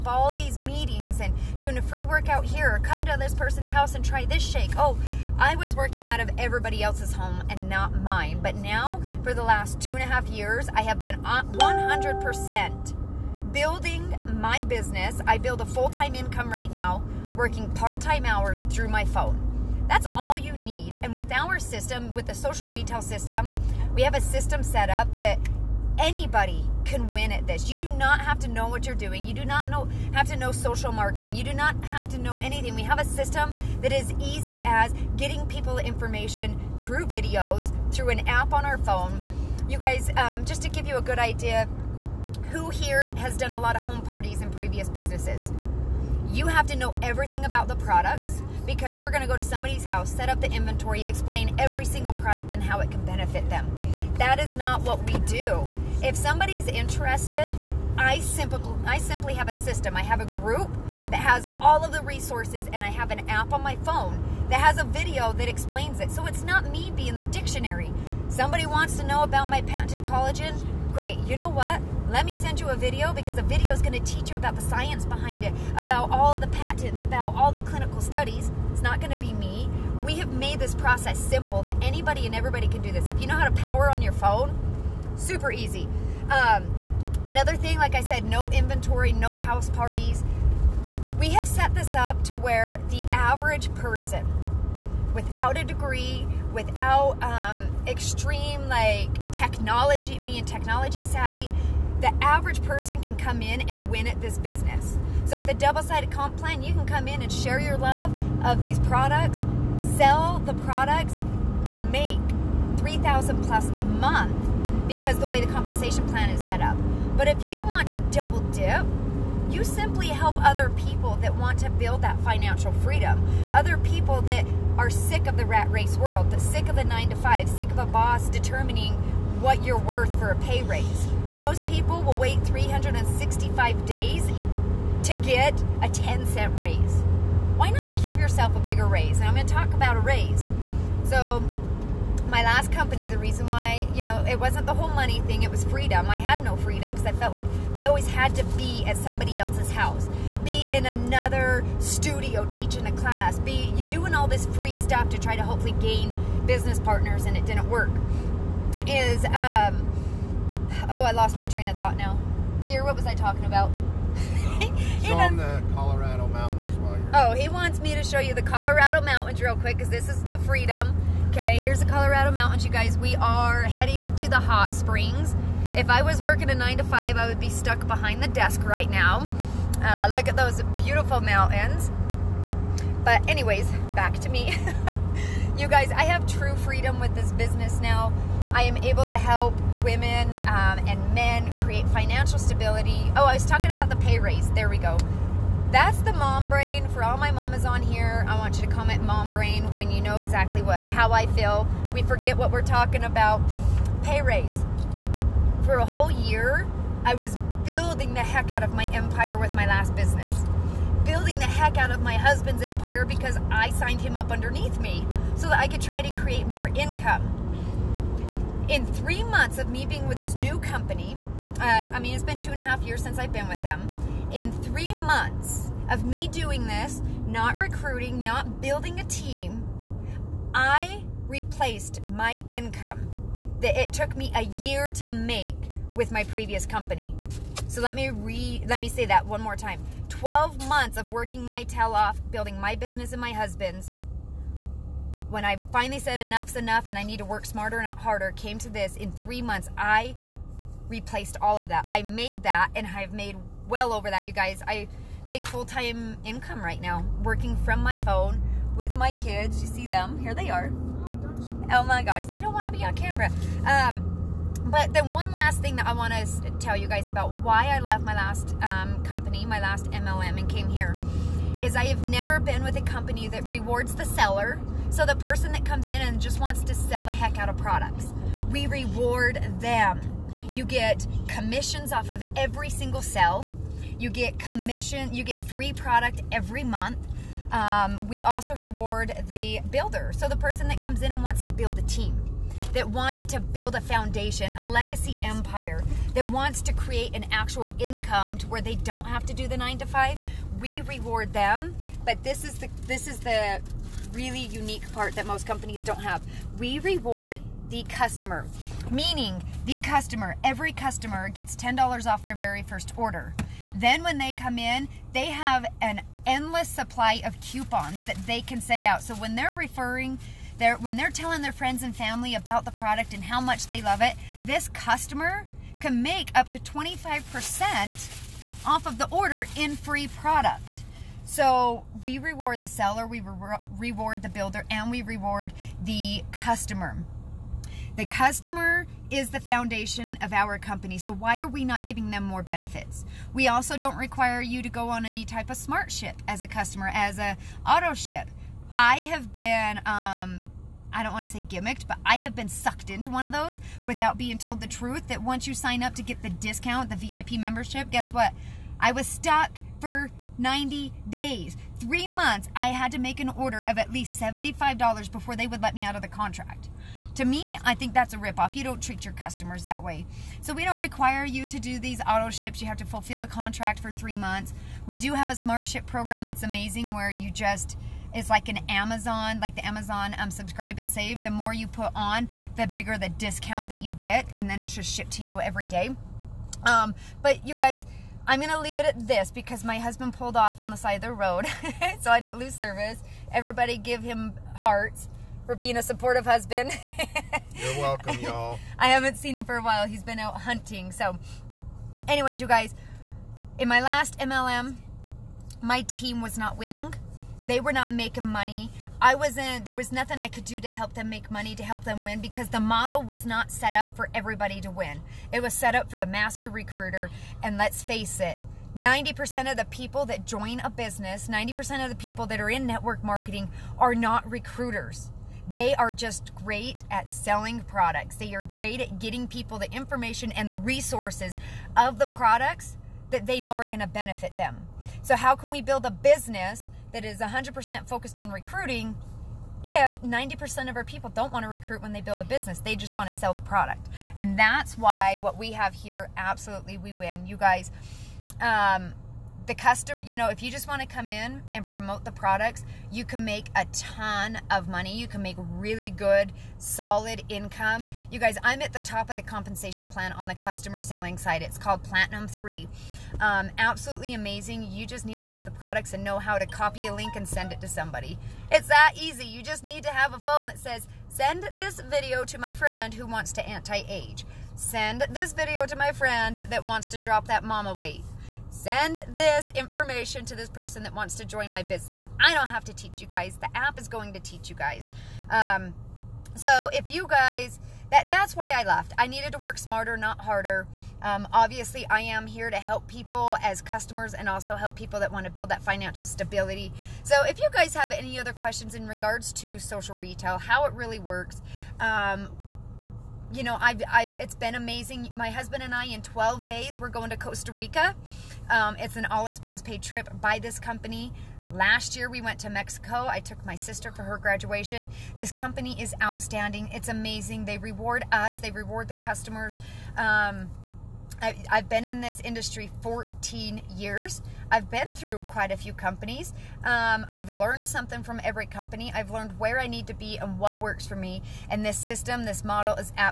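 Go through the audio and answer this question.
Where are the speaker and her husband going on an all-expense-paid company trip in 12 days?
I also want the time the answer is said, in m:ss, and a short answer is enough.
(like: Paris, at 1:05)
Costa Rica, at 8:27.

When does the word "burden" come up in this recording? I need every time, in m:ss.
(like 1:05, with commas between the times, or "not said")
not said.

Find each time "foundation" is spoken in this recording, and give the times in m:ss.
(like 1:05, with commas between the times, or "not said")
4:53, 5:39.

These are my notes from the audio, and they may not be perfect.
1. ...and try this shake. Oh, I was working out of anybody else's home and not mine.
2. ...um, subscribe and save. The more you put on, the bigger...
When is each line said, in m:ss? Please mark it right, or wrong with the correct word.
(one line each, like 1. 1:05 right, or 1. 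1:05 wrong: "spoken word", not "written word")
1. 0:03 wrong: "everybody", not "anybody"
2. 6:20 right.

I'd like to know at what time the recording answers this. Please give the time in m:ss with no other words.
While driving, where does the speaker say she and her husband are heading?
2:54.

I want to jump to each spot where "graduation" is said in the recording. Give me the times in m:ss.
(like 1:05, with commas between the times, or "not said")
8:34.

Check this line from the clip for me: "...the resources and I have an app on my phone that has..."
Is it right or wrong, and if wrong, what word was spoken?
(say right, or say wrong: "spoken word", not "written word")
right.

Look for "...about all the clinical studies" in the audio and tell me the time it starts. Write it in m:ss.
1:17.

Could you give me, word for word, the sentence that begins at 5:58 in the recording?
I was stuck for 90 days.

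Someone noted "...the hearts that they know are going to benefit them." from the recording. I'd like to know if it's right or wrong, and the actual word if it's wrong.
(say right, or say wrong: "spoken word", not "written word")
wrong: "products", not "hearts".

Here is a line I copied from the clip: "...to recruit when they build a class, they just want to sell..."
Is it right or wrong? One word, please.
wrong.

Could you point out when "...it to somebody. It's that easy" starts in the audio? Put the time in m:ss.
7:47.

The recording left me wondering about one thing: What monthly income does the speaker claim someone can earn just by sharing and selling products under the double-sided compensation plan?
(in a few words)
3000 plus.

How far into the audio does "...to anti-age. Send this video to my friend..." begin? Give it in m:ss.
7:53.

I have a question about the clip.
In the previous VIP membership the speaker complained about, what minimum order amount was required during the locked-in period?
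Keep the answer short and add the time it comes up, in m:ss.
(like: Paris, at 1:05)
$75, at 6:04.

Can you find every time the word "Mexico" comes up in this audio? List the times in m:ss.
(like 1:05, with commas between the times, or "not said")
8:32.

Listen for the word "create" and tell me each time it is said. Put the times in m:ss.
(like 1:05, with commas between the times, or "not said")
3:11, 3:36, 4:56.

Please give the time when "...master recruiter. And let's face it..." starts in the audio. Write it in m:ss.
6:56.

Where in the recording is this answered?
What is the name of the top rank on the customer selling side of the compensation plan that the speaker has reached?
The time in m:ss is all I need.
7:41.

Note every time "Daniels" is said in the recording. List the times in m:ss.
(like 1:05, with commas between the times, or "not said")
not said.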